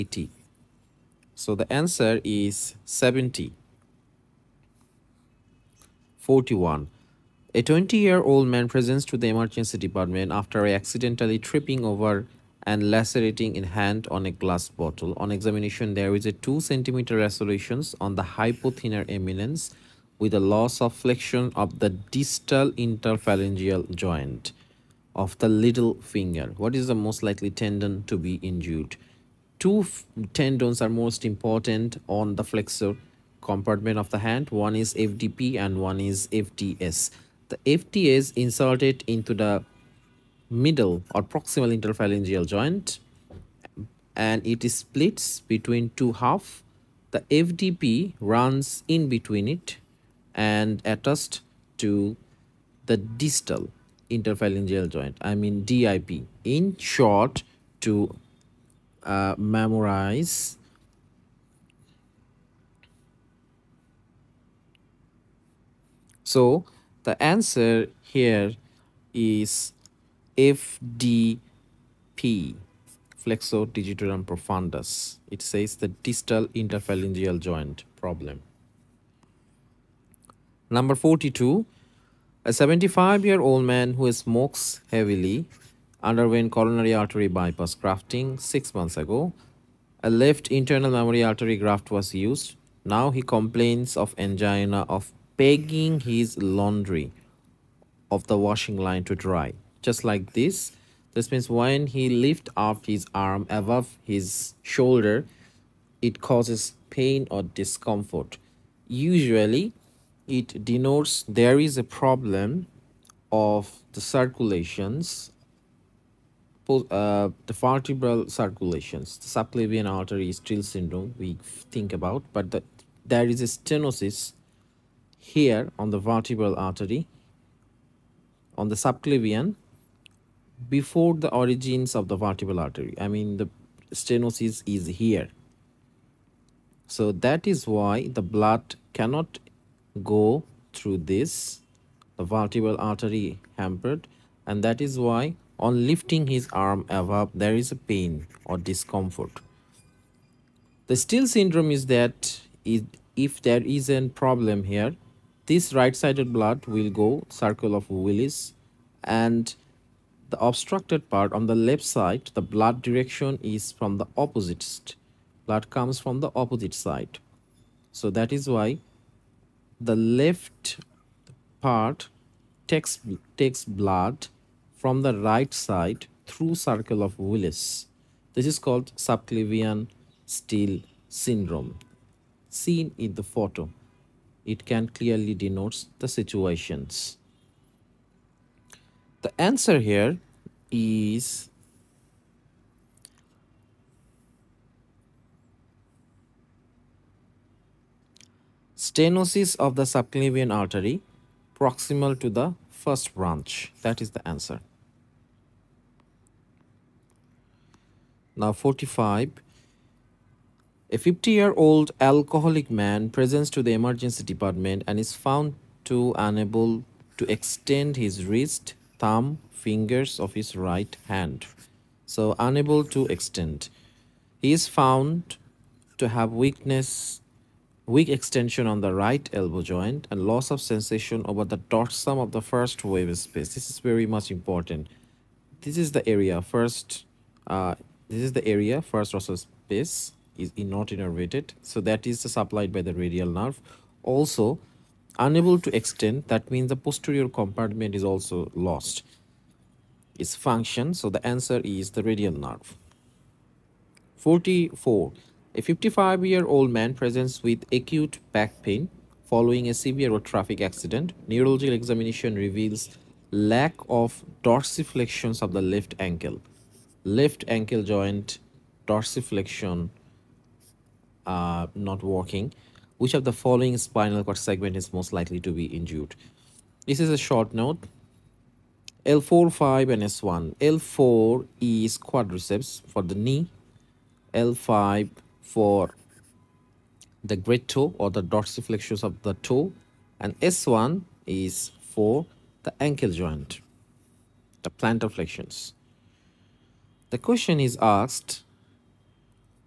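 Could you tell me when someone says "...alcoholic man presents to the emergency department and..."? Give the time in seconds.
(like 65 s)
211 s.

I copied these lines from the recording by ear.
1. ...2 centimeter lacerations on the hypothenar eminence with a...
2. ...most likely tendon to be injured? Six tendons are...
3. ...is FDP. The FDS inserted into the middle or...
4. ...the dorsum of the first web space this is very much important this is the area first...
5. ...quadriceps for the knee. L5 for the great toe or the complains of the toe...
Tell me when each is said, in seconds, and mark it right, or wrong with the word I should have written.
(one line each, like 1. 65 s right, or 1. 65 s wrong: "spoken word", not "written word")
1. 16 s right
2. 26 s wrong: "Two", not "Six"
3. 36 s wrong: "FDS", not "FDP"
4. 231 s right
5. 281 s wrong: "dorsiflexions", not "complains".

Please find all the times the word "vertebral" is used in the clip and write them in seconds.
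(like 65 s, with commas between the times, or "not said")
117 s, 125 s, 132 s, 142 s.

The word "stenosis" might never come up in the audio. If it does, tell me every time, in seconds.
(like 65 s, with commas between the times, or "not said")
123 s, 133 s, 198 s.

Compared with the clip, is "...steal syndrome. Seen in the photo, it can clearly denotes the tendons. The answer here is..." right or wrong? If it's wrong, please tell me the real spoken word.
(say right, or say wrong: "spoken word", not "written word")
wrong: "situations", not "tendons".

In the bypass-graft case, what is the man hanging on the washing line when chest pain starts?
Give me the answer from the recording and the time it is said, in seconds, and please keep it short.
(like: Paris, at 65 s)
laundry, at 96 s.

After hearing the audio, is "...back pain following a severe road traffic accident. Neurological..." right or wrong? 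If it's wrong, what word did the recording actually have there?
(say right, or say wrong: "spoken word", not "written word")
right.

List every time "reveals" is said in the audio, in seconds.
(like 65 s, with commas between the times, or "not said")
262 s.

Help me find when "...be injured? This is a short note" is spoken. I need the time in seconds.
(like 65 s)
275 s.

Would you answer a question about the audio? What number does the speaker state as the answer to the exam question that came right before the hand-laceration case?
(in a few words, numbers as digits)
70.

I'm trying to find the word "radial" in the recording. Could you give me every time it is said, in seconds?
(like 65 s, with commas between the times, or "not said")
242 s, 252 s.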